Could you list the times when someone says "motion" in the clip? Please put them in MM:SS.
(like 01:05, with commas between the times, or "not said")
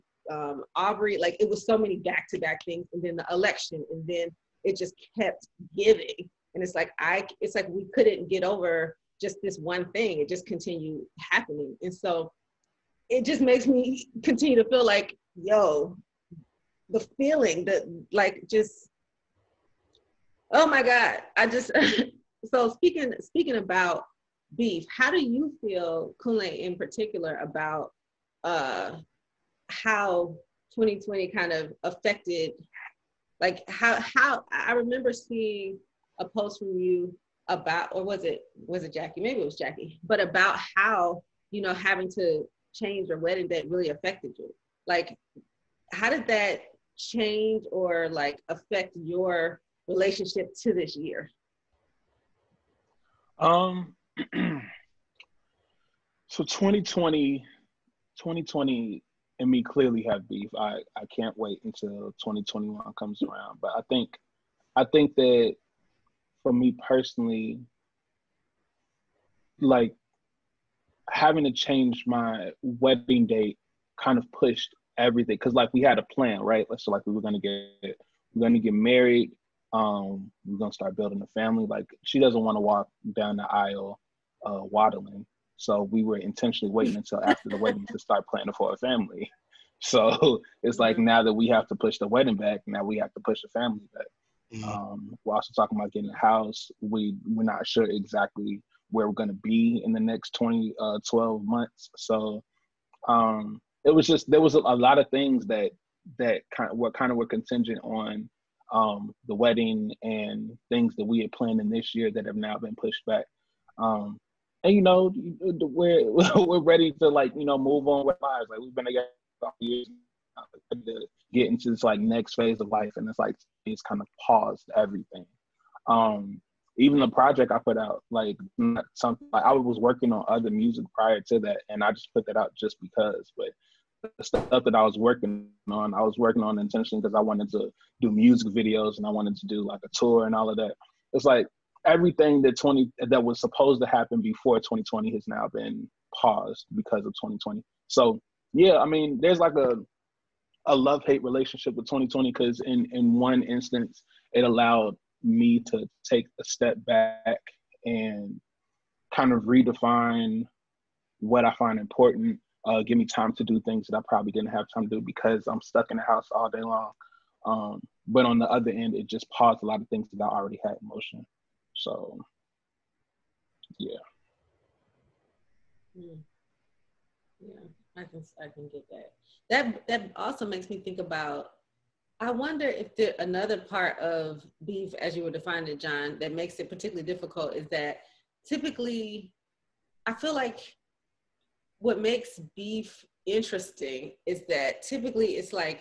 02:50.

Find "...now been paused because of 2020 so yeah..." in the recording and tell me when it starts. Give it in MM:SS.
02:25.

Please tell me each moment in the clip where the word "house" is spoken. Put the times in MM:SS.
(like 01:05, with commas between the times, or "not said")
01:36, 02:46.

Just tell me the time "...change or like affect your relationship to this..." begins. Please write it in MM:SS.
00:46.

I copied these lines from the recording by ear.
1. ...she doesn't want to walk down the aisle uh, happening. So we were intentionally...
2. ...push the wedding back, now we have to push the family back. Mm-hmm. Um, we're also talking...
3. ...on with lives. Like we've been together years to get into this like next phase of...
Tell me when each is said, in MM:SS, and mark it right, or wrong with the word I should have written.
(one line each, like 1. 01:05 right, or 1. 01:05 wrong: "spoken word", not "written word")
1. 01:22 wrong: "waddling", not "happening"
2. 01:31 right
3. 01:57 right.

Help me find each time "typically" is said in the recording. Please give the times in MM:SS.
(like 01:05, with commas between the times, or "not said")
03:08, 03:14.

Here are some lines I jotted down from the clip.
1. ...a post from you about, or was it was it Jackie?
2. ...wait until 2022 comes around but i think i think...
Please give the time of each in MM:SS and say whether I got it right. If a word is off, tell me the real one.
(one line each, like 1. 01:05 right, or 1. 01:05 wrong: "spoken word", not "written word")
1. 00:36 right
2. 01:01 wrong: "2021", not "2022".